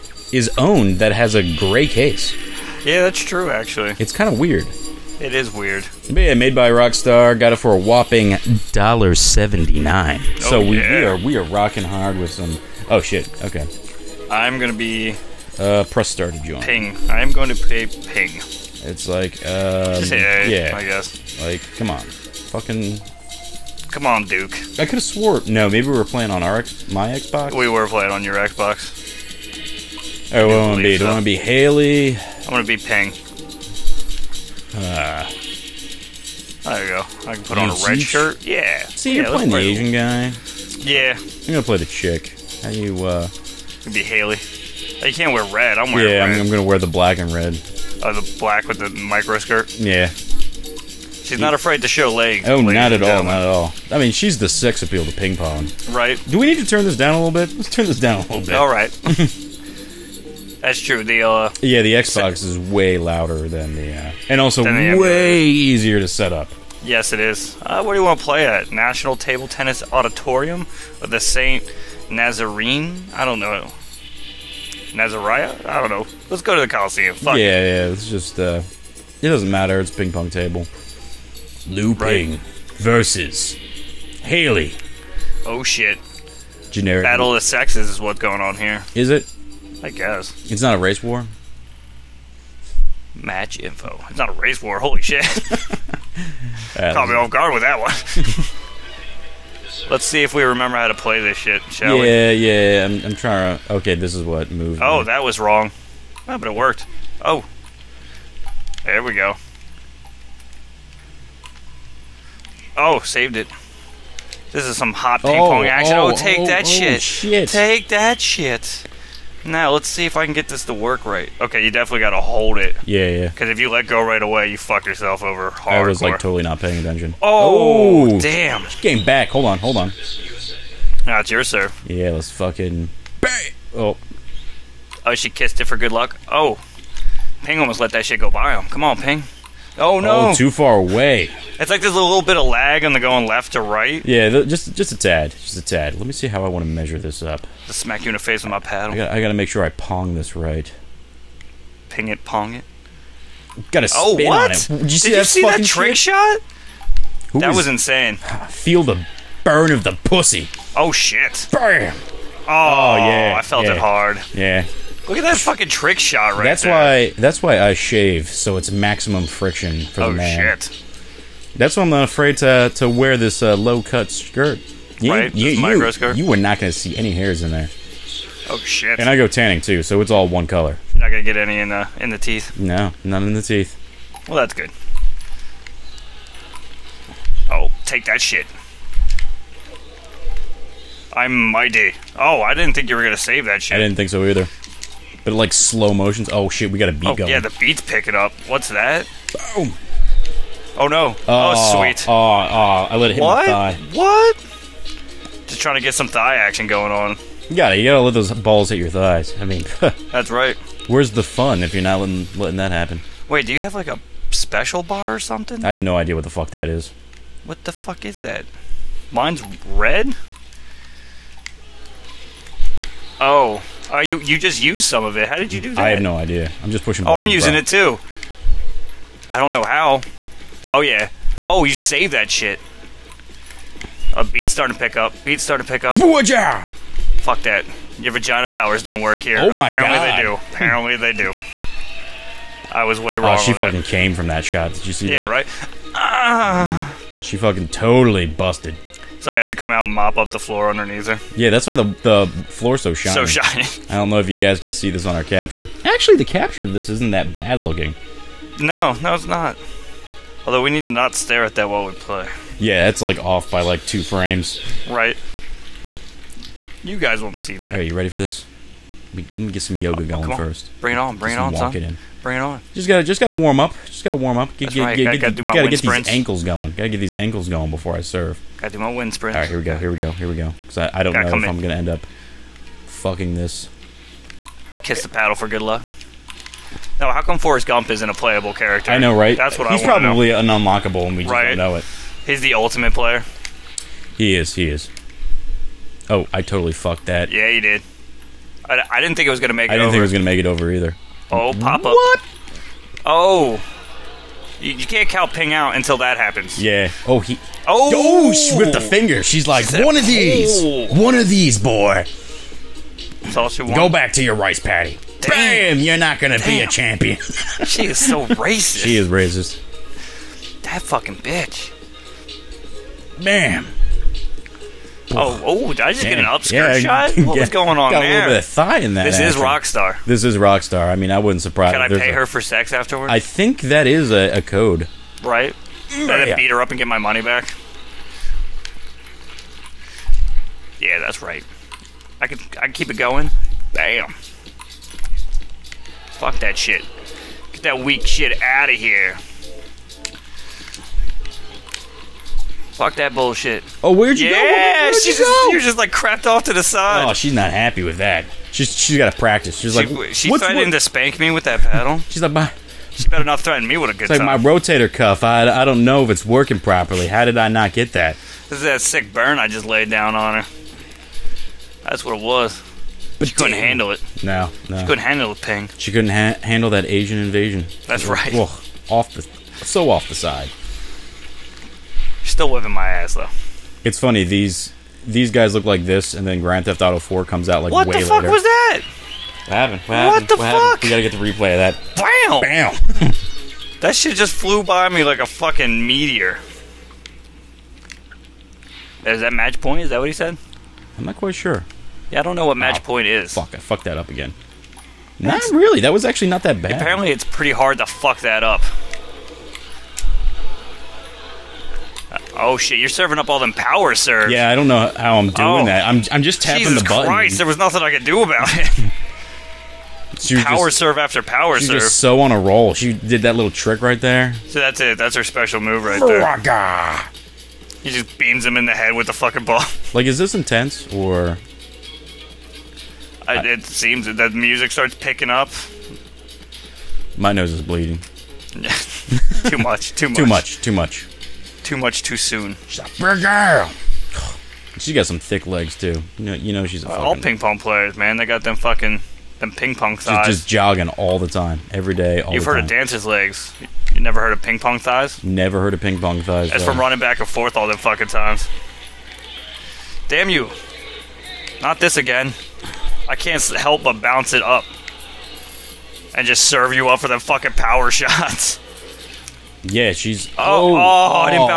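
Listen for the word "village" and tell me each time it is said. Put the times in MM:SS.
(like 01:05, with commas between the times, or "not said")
not said.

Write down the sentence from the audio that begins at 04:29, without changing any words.
Let me get some yoga oh, going first.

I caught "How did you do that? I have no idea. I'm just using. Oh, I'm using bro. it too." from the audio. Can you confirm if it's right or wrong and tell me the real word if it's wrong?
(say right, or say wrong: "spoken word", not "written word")
wrong: "pushing", not "using".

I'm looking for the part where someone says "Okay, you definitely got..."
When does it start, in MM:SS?
02:01.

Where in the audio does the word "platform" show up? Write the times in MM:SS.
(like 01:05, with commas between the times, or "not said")
not said.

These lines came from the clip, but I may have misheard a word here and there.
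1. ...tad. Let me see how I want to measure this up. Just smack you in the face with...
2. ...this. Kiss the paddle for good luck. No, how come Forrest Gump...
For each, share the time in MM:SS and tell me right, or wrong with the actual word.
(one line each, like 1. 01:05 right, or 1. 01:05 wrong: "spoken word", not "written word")
1. 02:25 right
2. 04:43 right.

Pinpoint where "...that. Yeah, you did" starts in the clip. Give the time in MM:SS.
04:57.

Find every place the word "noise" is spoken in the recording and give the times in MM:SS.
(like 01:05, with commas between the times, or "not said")
not said.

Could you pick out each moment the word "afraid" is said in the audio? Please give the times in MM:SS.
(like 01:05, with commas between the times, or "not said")
00:51, 02:52.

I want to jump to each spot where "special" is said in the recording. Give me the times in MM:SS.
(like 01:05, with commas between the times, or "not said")
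03:34, 07:05.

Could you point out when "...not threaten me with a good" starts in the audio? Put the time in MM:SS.
06:03.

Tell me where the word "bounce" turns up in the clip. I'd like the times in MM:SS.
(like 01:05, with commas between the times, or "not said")
07:44.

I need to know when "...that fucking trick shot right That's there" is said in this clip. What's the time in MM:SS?
02:45.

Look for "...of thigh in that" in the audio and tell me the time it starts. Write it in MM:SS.
05:28.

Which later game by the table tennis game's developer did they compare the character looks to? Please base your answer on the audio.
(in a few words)
Grand Theft Auto 4.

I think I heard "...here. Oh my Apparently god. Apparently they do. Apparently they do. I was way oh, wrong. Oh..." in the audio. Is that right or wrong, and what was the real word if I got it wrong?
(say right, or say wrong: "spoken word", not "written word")
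right.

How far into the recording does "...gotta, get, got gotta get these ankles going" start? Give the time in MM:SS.
04:35.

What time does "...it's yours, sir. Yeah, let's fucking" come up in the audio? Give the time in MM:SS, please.
02:11.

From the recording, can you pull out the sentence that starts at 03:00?
You're not gonna get any in the in the teeth.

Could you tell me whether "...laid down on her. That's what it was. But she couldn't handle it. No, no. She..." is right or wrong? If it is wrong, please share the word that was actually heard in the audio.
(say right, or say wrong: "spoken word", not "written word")
right.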